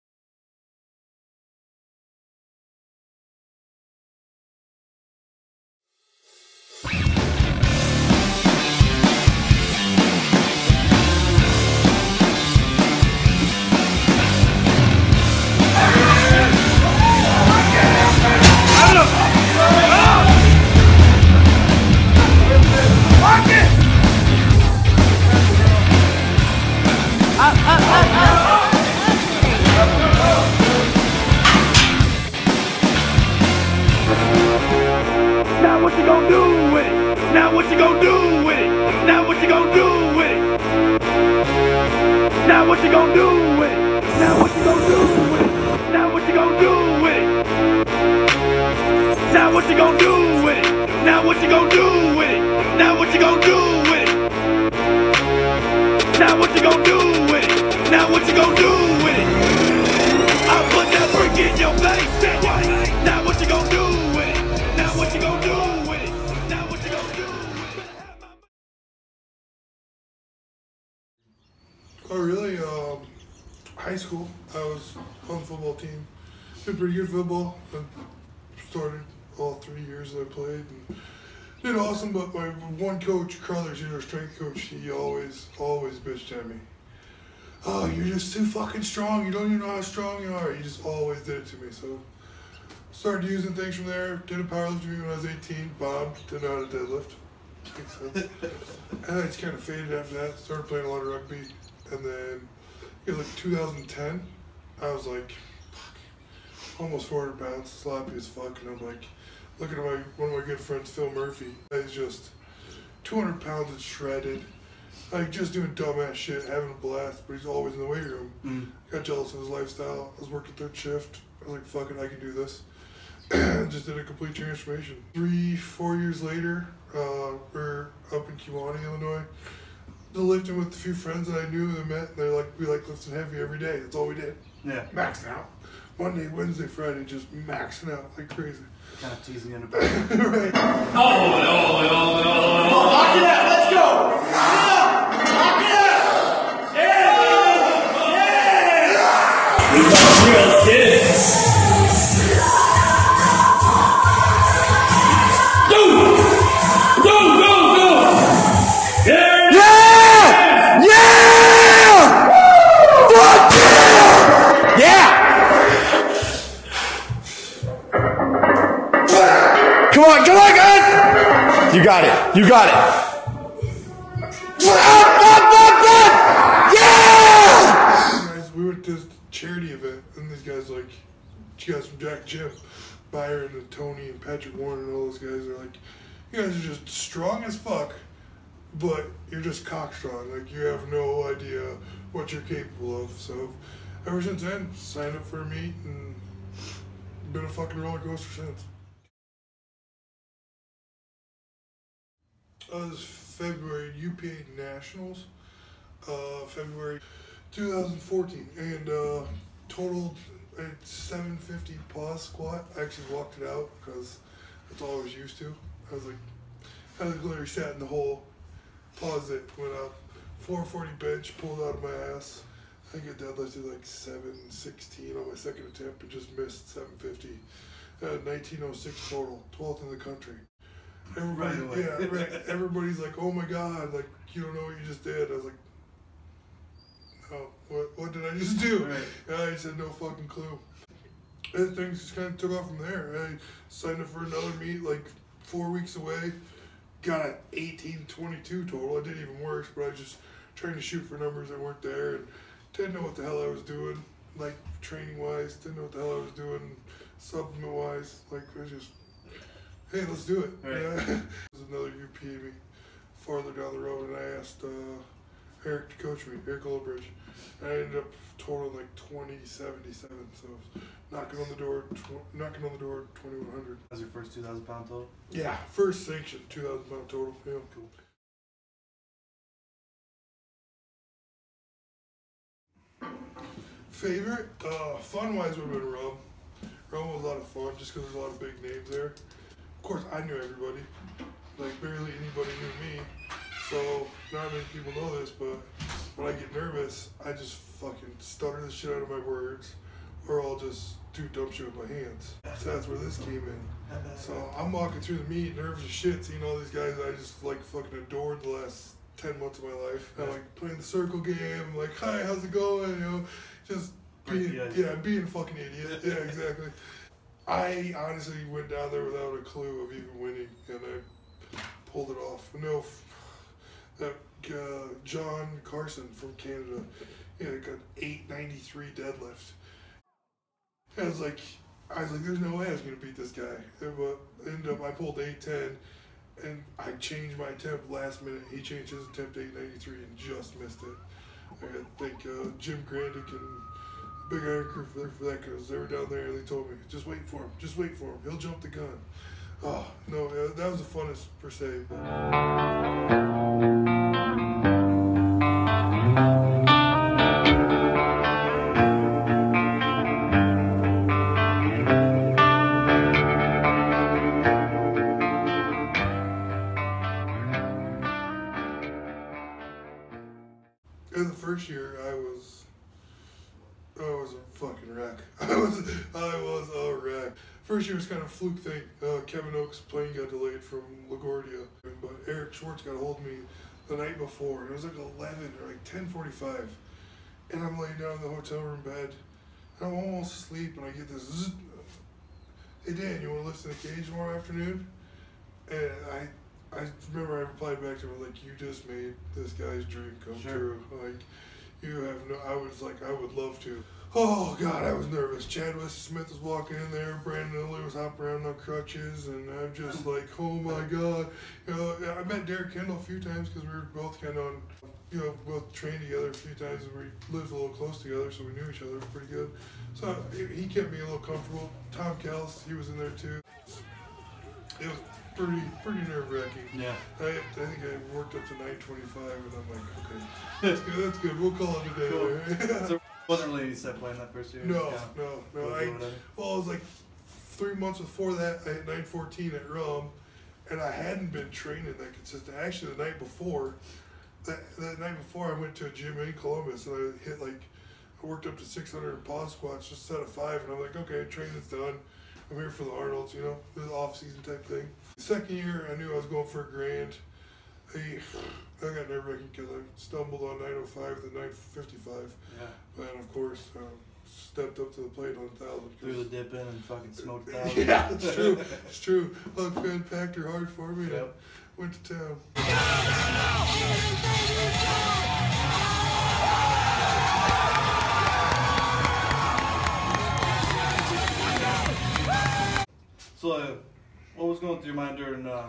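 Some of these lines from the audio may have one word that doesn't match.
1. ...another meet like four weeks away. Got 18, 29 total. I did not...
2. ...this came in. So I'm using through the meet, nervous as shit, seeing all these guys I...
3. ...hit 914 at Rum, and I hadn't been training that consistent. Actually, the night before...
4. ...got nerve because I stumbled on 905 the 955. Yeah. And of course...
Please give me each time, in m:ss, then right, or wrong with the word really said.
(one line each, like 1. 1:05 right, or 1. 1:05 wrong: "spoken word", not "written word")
1. 4:04 wrong: "22", not "29"
2. 5:02 wrong: "walking", not "using"
3. 7:18 right
4. 7:38 right.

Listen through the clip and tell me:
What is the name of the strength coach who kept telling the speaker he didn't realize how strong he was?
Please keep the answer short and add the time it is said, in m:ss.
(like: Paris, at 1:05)
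Carlos, at 1:23.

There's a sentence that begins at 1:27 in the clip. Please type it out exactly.
Oh, you're just too fucking strong.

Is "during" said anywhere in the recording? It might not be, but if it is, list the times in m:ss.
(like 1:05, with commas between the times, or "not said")
8:05.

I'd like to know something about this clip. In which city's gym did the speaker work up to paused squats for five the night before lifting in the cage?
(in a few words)
Columbus.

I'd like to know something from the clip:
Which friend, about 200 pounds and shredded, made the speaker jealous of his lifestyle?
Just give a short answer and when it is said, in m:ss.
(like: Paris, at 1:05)
Phil Murphy, at 1:50.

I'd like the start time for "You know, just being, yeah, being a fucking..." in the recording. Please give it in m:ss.
5:12.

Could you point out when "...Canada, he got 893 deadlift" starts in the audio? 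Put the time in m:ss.
5:26.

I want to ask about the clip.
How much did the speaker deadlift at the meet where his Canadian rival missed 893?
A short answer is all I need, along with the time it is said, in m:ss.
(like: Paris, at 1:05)
810, at 5:35.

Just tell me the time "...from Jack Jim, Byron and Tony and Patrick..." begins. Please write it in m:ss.
3:01.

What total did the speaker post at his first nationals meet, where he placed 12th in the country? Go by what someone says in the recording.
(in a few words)
1906.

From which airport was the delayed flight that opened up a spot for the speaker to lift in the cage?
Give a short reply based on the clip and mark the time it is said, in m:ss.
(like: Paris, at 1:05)
LaGuardia, at 6:21.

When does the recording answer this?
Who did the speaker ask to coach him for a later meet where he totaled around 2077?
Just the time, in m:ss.
4:26.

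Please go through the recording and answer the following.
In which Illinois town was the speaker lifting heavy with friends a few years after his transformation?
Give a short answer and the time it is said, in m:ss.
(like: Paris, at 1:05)
Kewanee, at 2:08.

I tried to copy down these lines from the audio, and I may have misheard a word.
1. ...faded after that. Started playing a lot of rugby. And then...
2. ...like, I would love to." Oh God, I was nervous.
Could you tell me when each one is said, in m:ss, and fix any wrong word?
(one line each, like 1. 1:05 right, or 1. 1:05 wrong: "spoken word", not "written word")
1. 1:39 right
2. 6:42 right.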